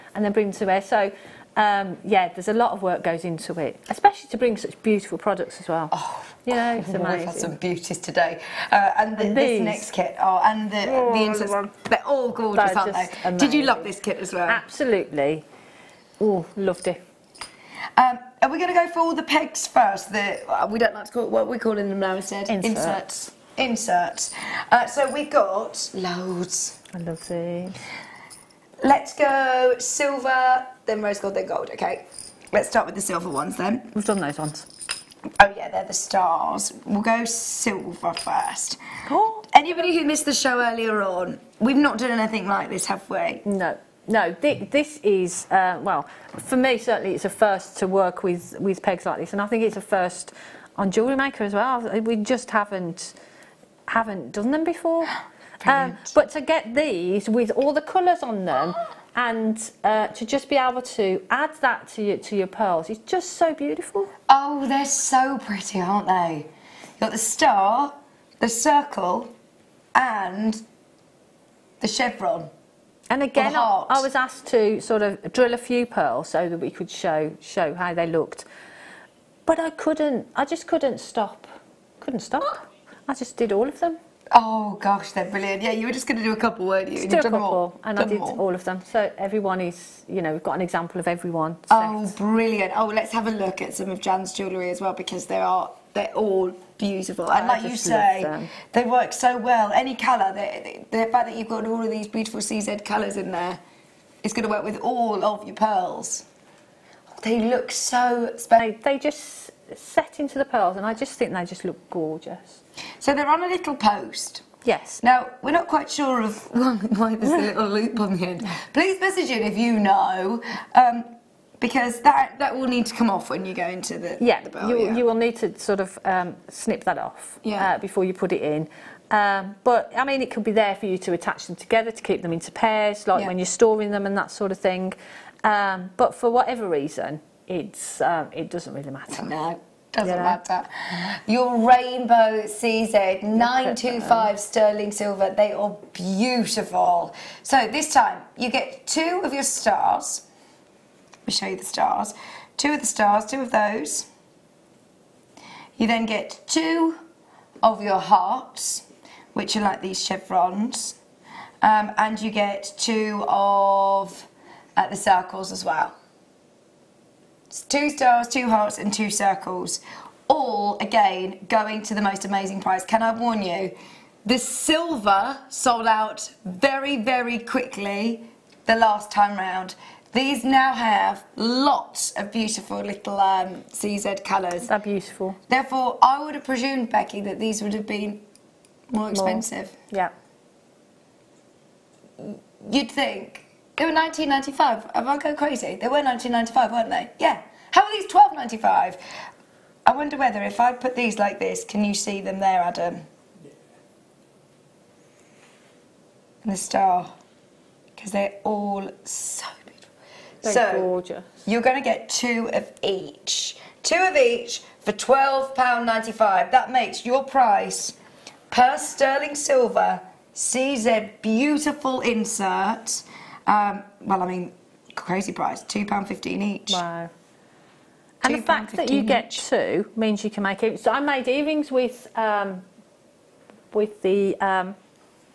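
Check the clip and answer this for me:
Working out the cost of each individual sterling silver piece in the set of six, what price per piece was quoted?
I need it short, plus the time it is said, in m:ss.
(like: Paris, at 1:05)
£2.15, at 3:45.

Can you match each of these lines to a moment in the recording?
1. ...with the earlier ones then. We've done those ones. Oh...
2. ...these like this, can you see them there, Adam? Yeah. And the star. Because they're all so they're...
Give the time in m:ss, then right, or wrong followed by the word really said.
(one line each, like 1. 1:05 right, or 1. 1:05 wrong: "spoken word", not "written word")
1. 0:32 wrong: "silver", not "earlier"
2. 3:20 right.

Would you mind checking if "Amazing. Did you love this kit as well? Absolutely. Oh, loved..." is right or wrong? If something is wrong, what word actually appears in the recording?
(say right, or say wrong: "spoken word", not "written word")
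right.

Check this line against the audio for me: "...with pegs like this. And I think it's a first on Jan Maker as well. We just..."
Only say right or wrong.
wrong.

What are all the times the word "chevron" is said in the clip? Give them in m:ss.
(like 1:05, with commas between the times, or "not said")
1:11, 2:40.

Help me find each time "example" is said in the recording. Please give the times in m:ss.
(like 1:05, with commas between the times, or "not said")
1:30.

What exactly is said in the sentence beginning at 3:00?
These now have lots of beautiful little um, CZ colours.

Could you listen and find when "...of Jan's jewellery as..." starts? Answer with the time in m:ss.
1:33.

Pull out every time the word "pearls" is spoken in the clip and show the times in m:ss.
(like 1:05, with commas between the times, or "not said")
1:02, 1:15, 1:45, 1:50.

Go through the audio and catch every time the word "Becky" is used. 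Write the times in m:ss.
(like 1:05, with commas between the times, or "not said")
3:06.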